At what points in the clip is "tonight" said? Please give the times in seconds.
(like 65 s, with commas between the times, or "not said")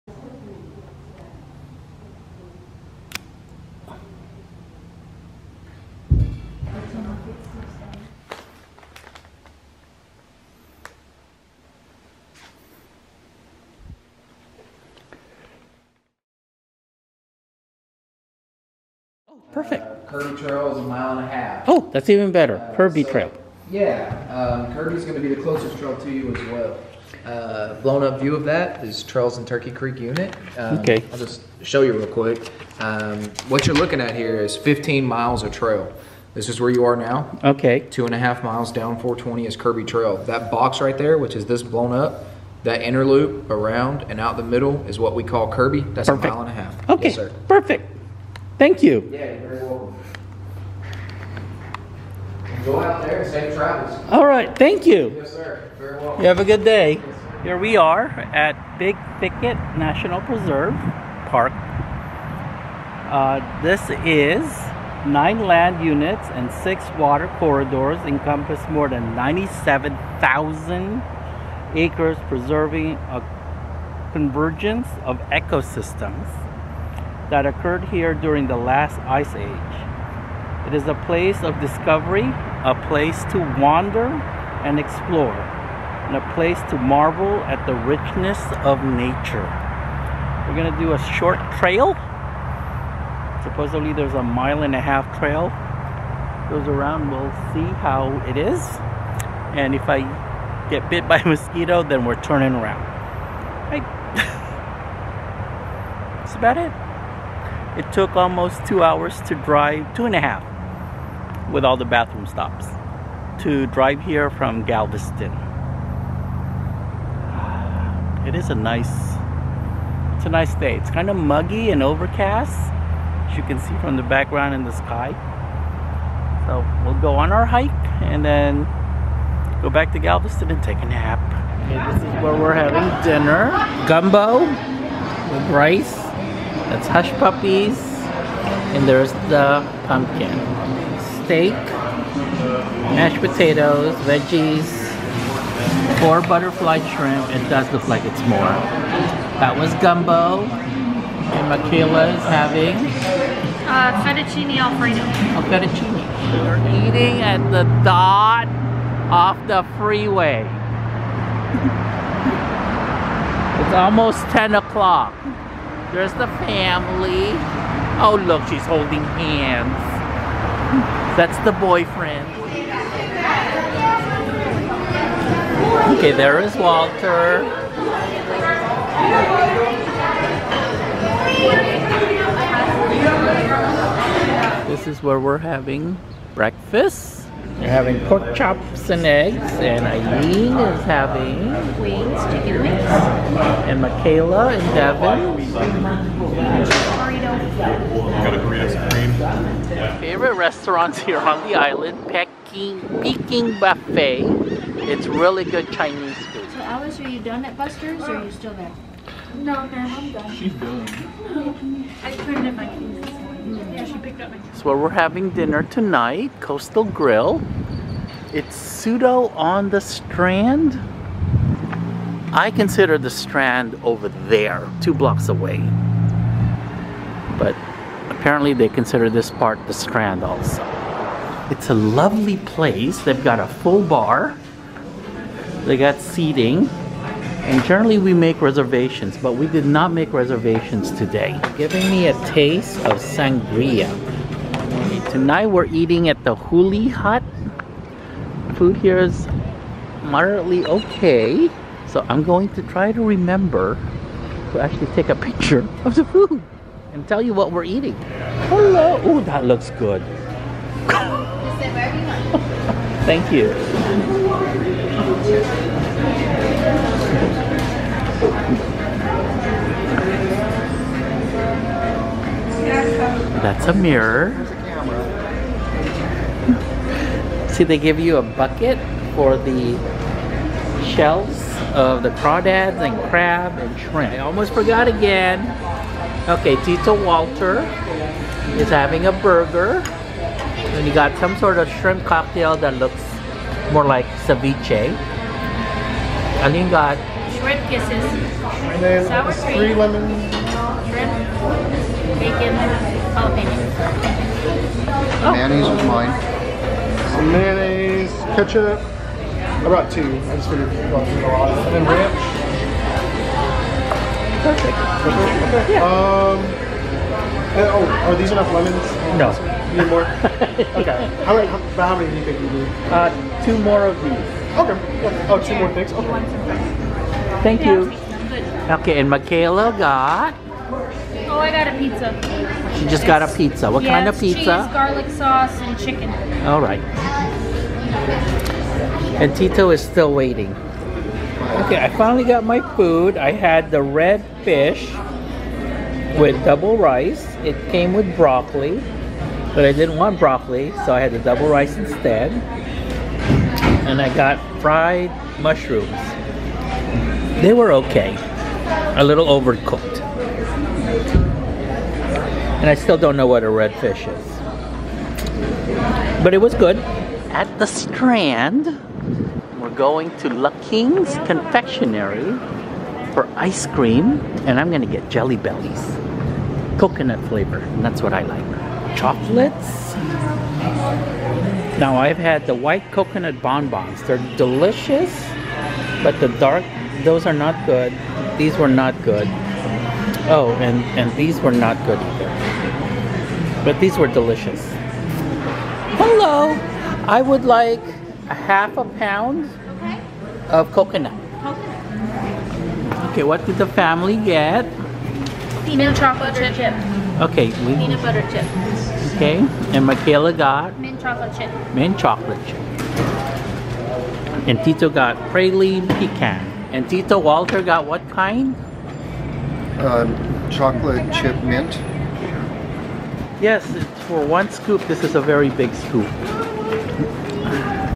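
215 s, 245 s.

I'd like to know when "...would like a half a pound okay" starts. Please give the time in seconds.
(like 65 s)
397 s.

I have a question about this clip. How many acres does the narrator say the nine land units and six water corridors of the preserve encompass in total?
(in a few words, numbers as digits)
more than 97,000.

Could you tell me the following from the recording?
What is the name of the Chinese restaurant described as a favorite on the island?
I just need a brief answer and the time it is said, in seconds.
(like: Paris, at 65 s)
Peking Buffet, at 203 s.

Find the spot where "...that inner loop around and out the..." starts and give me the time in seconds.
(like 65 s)
42 s.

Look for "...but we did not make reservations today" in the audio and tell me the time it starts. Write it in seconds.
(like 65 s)
239 s.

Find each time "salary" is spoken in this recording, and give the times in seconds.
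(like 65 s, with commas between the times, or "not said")
not said.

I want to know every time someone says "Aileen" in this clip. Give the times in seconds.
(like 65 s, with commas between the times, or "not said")
189 s.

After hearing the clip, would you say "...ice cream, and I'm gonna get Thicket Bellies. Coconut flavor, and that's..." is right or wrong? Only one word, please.
wrong.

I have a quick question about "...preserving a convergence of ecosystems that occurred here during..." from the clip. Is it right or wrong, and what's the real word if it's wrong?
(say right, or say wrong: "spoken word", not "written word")
right.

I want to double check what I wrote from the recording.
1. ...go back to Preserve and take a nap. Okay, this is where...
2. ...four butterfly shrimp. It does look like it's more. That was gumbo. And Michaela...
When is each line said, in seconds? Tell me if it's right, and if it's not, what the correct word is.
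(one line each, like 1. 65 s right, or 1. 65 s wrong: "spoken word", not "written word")
1. 129 s wrong: "Galveston", not "Preserve"
2. 145 s right.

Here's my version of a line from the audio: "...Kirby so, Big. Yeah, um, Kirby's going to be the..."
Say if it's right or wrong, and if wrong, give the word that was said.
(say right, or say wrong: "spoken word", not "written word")
wrong: "Trail", not "Big".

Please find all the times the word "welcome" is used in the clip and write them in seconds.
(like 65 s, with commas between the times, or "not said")
49 s, 55 s.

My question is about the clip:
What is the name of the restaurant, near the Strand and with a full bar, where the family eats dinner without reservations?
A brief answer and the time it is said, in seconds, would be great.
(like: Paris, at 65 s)
Coastal Grill, at 216 s.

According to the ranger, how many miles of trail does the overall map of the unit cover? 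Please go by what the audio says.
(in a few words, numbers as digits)
15 miles.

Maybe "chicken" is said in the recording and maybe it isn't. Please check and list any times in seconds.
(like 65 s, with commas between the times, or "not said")
192 s, 335 s.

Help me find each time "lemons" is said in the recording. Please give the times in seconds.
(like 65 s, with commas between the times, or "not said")
299 s, 318 s.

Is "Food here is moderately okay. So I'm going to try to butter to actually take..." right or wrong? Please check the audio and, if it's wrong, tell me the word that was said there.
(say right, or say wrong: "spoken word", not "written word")
wrong: "remember", not "butter".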